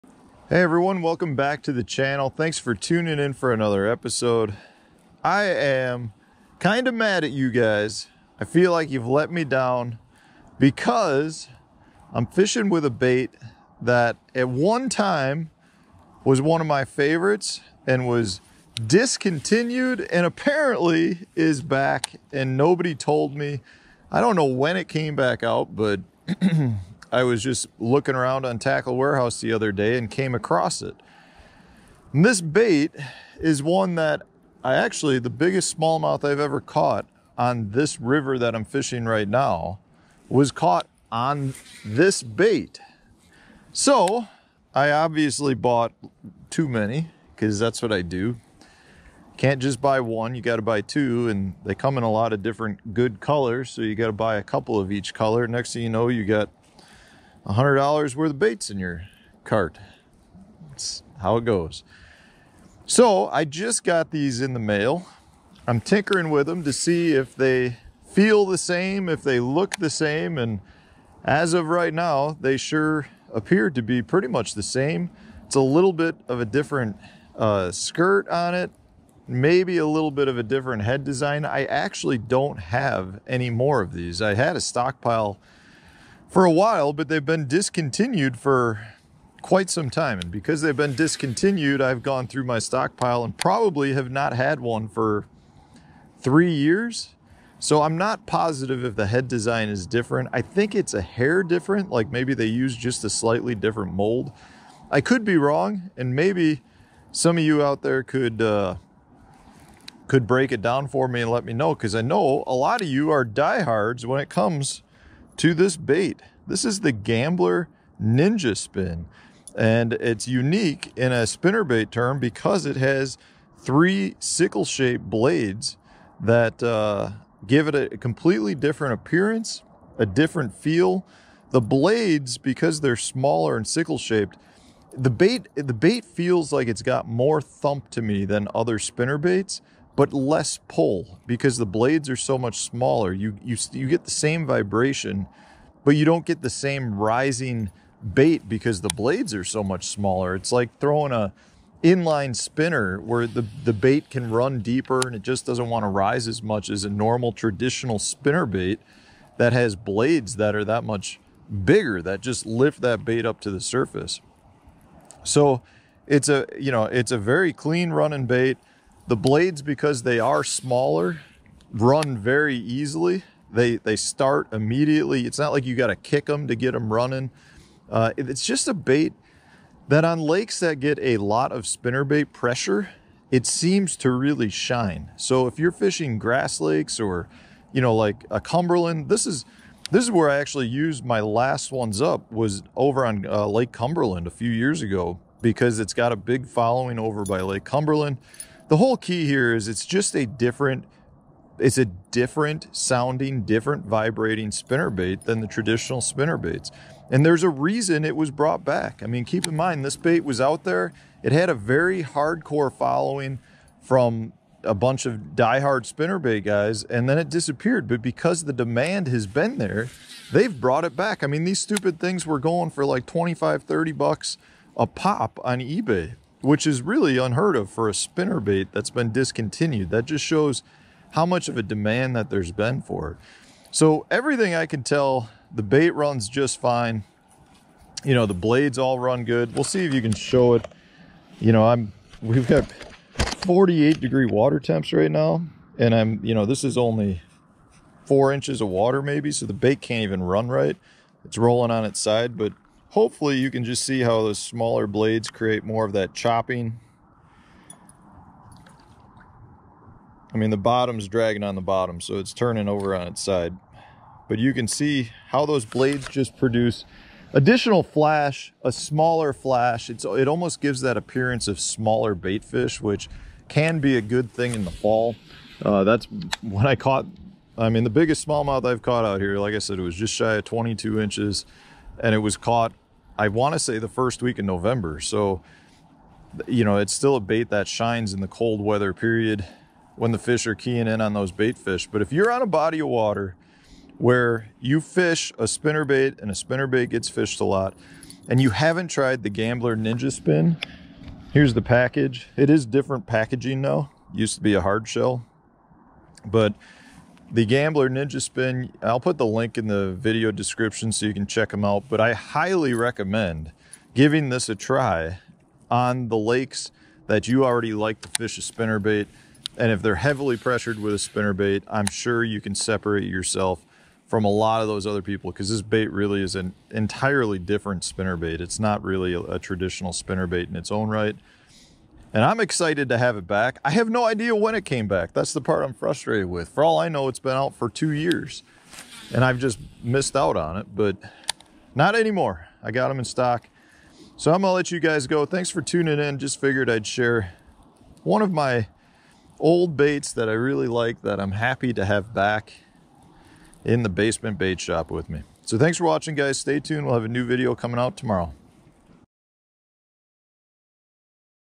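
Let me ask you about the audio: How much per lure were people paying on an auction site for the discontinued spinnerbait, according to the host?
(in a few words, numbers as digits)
25 to 30 dollars.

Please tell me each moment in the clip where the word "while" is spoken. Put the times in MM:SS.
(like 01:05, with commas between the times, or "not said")
01:26.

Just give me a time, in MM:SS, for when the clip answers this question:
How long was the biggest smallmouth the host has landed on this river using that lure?
04:39.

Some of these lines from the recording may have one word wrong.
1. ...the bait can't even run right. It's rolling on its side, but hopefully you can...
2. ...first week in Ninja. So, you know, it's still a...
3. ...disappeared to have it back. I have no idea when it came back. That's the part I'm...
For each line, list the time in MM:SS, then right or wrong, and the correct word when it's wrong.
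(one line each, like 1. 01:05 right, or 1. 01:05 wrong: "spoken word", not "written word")
1. 04:09 right
2. 04:43 wrong: "November", not "Ninja"
3. 05:32 wrong: "excited", not "disappeared".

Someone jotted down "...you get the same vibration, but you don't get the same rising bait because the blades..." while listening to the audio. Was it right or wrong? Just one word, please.
right.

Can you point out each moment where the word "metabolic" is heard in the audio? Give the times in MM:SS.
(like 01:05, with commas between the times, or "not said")
not said.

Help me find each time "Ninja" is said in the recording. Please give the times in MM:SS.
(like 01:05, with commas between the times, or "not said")
01:57, 04:59, 05:07.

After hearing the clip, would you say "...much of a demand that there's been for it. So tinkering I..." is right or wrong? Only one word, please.
wrong.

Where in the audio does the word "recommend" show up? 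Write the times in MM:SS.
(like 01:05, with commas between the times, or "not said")
05:12.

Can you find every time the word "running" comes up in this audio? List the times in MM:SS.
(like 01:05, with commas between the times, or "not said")
02:47, 02:56.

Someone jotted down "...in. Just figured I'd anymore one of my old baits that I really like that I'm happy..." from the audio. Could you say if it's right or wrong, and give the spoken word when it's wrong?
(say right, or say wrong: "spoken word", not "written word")
wrong: "share", not "anymore".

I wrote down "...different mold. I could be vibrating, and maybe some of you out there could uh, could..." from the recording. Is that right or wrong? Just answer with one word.
wrong.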